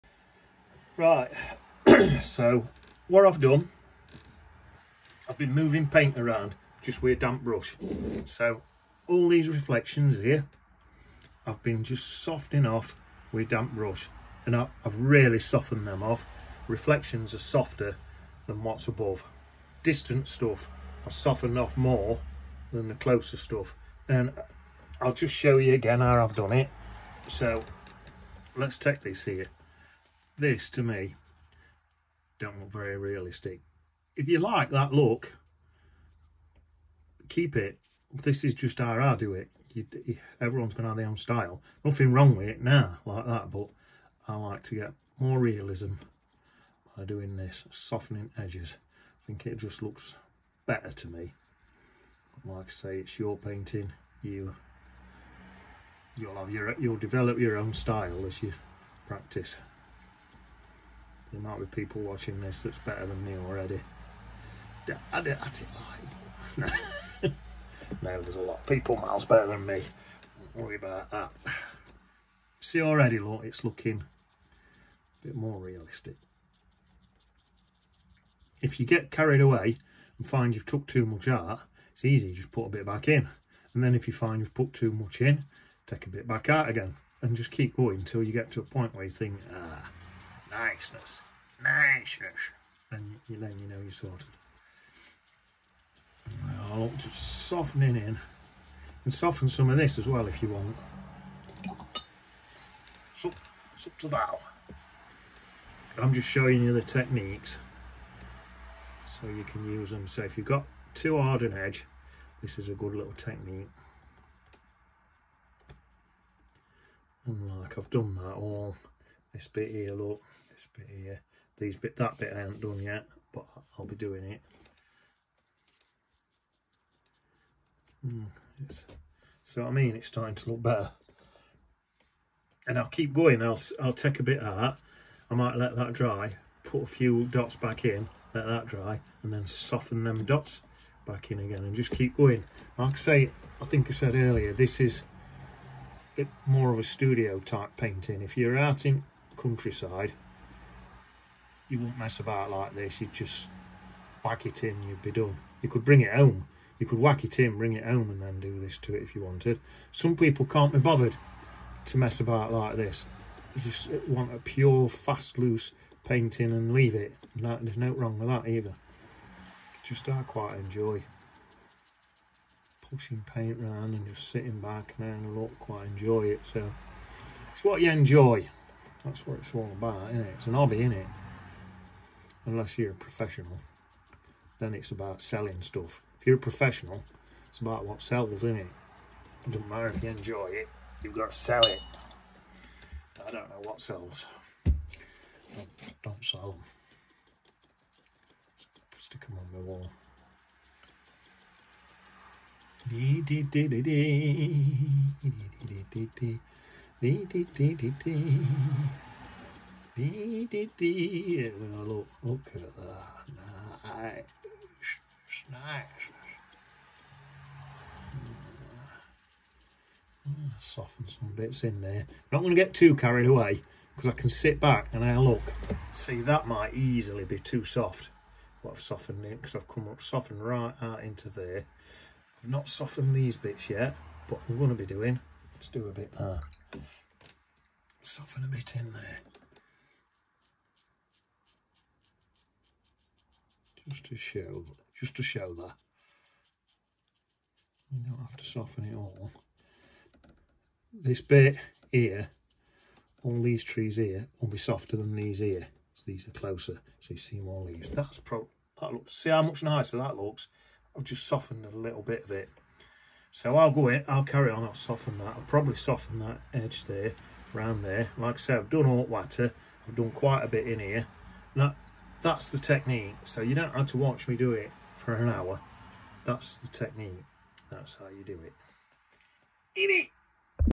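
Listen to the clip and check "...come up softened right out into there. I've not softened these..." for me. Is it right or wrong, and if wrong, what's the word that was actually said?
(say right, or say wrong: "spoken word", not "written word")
right.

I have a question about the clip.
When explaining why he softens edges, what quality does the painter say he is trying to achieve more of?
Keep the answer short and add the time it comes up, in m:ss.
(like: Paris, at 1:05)
Realism, at 0:45.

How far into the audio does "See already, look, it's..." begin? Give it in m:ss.
1:12.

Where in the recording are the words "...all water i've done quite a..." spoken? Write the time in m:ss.
4:28.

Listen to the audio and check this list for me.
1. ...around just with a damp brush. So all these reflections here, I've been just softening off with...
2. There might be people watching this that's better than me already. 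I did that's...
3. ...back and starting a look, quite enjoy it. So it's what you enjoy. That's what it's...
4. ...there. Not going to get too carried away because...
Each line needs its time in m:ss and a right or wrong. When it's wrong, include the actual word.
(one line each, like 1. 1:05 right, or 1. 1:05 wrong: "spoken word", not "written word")
1. 0:06 right
2. 1:01 right
3. 2:54 wrong: "having", not "starting"
4. 3:41 right.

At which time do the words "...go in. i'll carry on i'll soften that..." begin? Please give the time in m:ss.
4:23.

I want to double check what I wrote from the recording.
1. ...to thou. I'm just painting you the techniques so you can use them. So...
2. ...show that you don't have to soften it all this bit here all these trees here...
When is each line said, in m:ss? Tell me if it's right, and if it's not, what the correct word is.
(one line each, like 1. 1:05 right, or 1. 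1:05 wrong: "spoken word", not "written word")
1. 1:43 wrong: "showing", not "painting"
2. 4:05 right.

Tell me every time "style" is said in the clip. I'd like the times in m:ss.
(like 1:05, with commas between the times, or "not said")
0:41, 0:57.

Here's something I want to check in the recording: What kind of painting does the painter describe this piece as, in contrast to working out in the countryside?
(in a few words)
Studio type painting.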